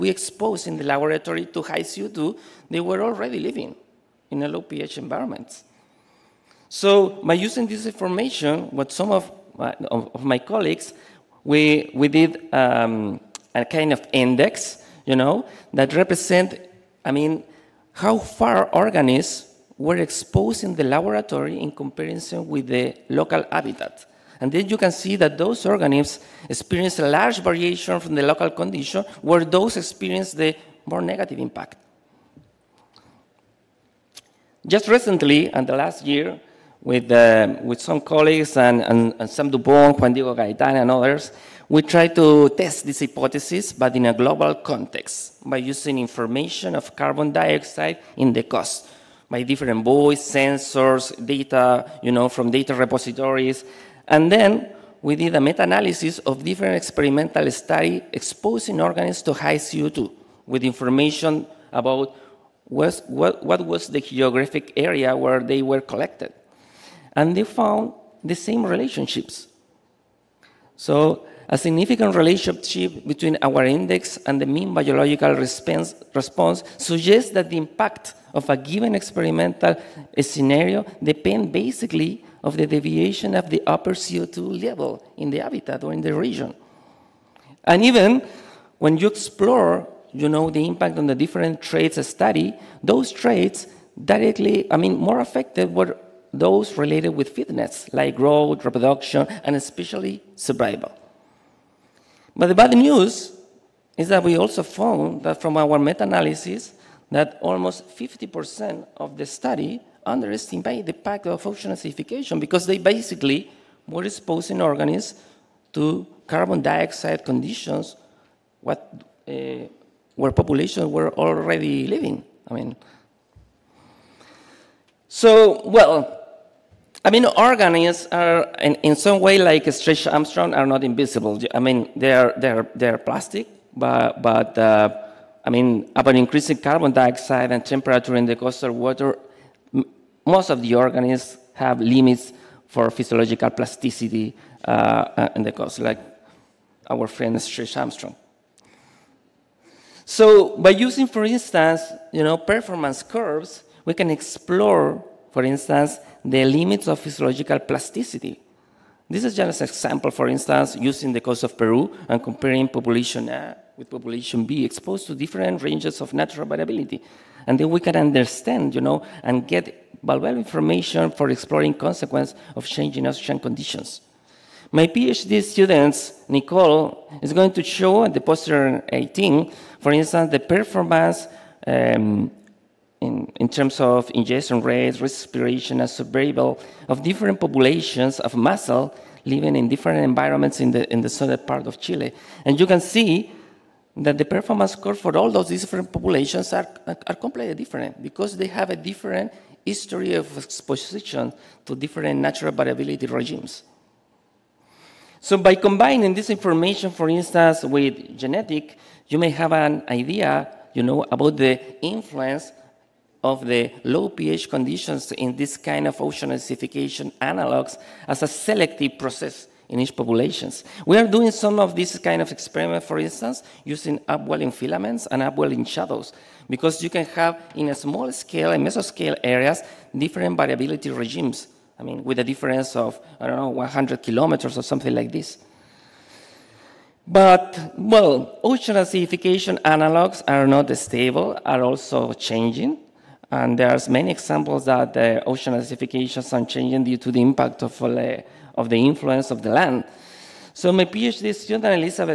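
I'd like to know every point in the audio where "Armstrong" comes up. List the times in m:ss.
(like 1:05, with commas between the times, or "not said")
2:10, 2:27.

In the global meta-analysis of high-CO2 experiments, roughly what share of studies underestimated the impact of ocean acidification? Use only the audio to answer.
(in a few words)
50%.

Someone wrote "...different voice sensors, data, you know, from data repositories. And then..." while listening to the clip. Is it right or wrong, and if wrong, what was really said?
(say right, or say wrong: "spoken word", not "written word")
right.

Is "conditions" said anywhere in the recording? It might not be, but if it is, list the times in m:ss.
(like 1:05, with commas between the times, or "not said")
0:28, 1:57, 2:53, 3:34.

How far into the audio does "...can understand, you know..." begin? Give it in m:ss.
2:47.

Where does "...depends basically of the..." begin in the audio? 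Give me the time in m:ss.
1:21.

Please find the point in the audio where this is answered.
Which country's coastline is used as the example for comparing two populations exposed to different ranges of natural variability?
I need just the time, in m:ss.
2:41.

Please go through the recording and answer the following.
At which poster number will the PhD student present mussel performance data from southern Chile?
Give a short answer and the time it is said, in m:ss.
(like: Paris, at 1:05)
18, at 2:58.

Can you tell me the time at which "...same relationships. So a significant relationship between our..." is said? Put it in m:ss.
1:08.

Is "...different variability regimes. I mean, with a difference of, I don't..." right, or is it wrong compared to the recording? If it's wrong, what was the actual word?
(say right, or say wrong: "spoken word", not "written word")
right.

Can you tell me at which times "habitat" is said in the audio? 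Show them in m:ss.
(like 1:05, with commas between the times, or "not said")
0:23, 1:25.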